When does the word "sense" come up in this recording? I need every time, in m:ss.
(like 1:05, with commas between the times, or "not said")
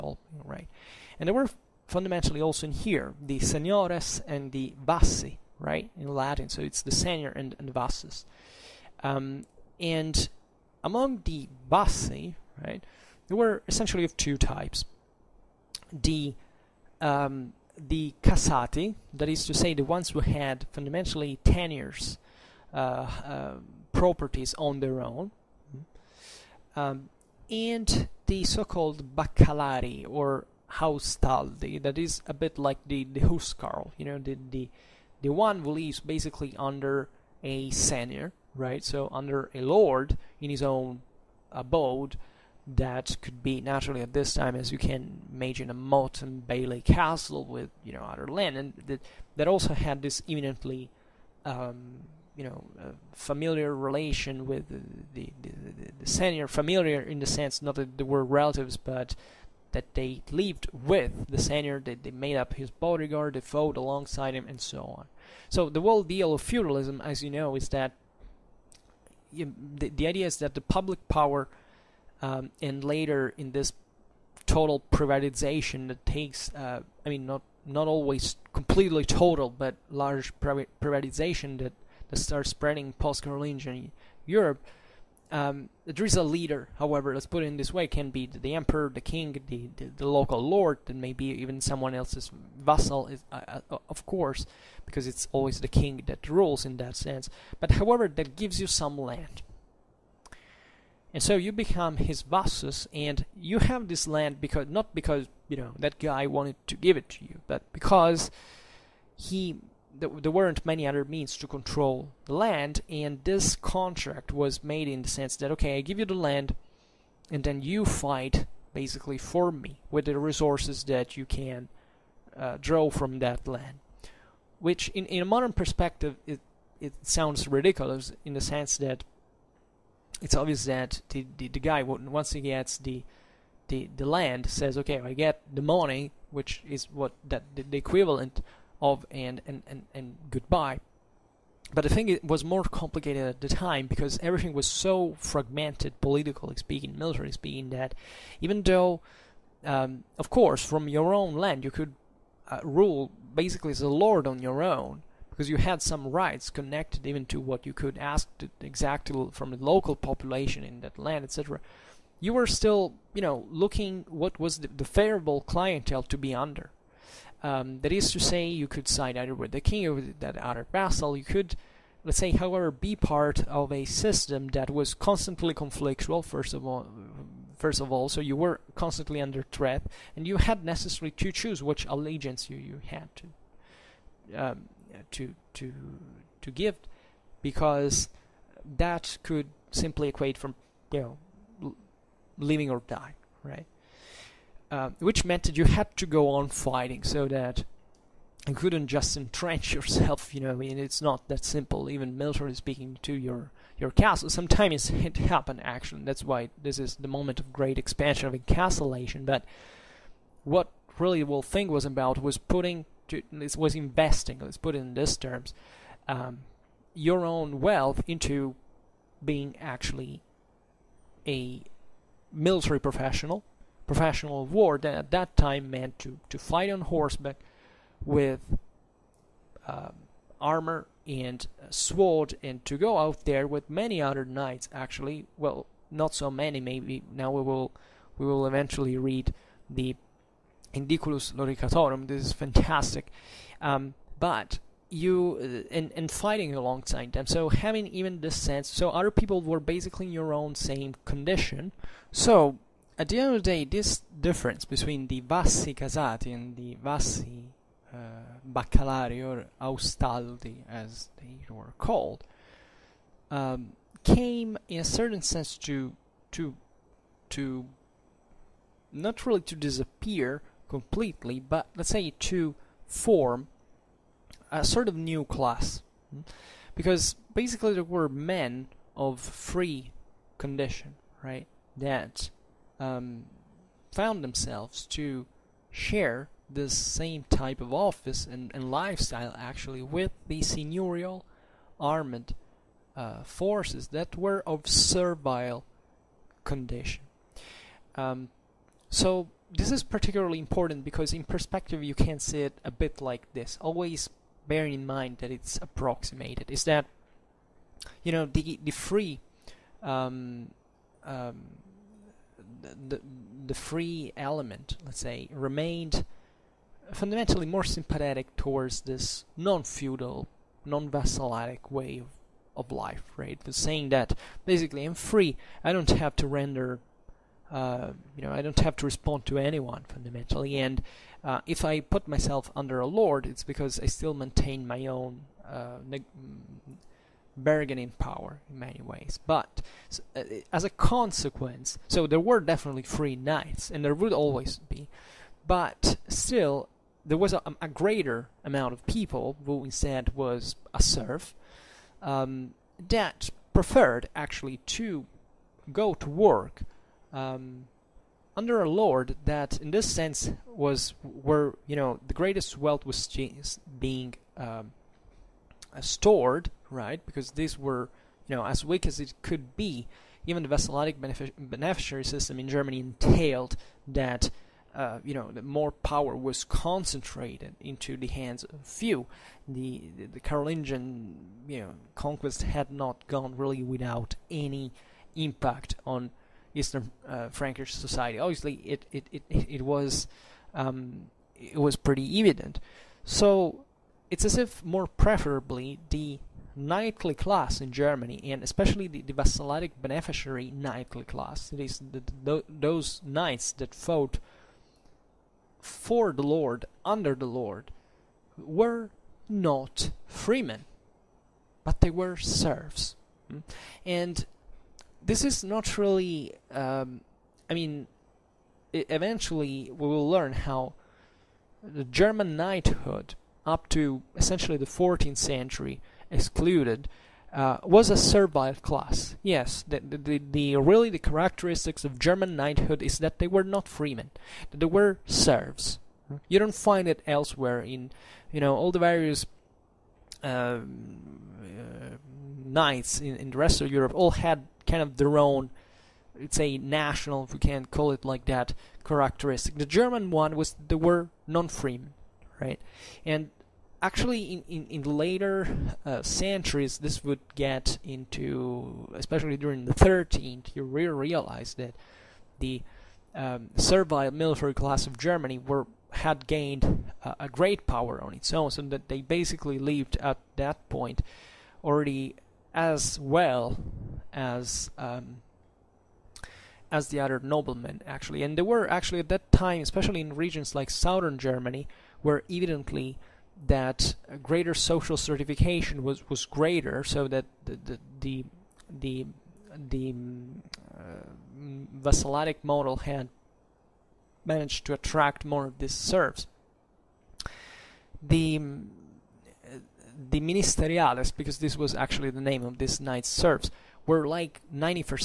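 0:57, 1:36, 1:55, 2:08, 4:08, 4:25, 5:59.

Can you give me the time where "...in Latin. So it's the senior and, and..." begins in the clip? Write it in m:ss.
0:05.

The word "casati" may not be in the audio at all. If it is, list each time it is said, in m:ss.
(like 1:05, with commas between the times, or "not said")
0:18, 4:15.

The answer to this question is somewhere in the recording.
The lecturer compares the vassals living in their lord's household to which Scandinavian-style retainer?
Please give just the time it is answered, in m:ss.
0:33.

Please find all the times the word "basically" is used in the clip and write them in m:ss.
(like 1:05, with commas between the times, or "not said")
0:36, 1:58, 2:33, 4:09, 4:37, 5:24, 7:49.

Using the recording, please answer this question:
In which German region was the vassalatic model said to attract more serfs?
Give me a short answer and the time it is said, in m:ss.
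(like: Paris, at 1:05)
southern Germany, at 8:00.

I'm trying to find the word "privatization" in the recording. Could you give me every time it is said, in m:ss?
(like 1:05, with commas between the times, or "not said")
1:14, 1:20.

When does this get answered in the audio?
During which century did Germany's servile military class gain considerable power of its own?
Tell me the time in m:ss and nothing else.
7:39.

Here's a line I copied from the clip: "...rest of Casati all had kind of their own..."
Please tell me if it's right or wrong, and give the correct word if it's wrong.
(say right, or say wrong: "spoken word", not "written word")
wrong: "Europe", not "Casati".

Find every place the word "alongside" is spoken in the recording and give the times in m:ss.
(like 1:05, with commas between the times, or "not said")
1:03, 4:06.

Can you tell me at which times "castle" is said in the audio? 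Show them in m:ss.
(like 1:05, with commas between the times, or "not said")
0:46, 3:23.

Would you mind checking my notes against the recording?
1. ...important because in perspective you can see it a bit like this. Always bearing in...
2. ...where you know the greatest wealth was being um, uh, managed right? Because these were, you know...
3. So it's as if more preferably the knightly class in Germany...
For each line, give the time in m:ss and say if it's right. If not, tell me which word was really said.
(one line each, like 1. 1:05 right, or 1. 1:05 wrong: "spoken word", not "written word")
1. 5:00 right
2. 6:01 wrong: "stored", not "managed"
3. 6:33 right.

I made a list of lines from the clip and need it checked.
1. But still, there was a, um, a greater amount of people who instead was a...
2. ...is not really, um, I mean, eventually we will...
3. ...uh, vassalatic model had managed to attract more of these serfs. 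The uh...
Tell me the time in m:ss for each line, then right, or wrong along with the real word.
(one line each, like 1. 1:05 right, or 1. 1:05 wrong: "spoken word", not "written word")
1. 5:45 right
2. 6:55 right
3. 8:10 right.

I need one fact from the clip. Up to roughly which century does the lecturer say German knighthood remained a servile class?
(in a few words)
14th century.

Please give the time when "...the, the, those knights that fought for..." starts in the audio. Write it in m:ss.
6:41.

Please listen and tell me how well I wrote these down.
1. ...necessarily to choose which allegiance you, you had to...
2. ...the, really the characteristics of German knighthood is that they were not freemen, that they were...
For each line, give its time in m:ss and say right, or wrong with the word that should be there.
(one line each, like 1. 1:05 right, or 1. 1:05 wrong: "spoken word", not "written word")
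1. 3:00 right
2. 7:10 right.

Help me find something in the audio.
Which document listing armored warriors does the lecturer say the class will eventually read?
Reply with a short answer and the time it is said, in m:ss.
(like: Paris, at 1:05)
Indiculus Loricatorum, at 4:00.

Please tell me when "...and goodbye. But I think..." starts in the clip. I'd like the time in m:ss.
2:19.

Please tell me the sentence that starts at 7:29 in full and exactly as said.
The German one was they were non-freemen, right?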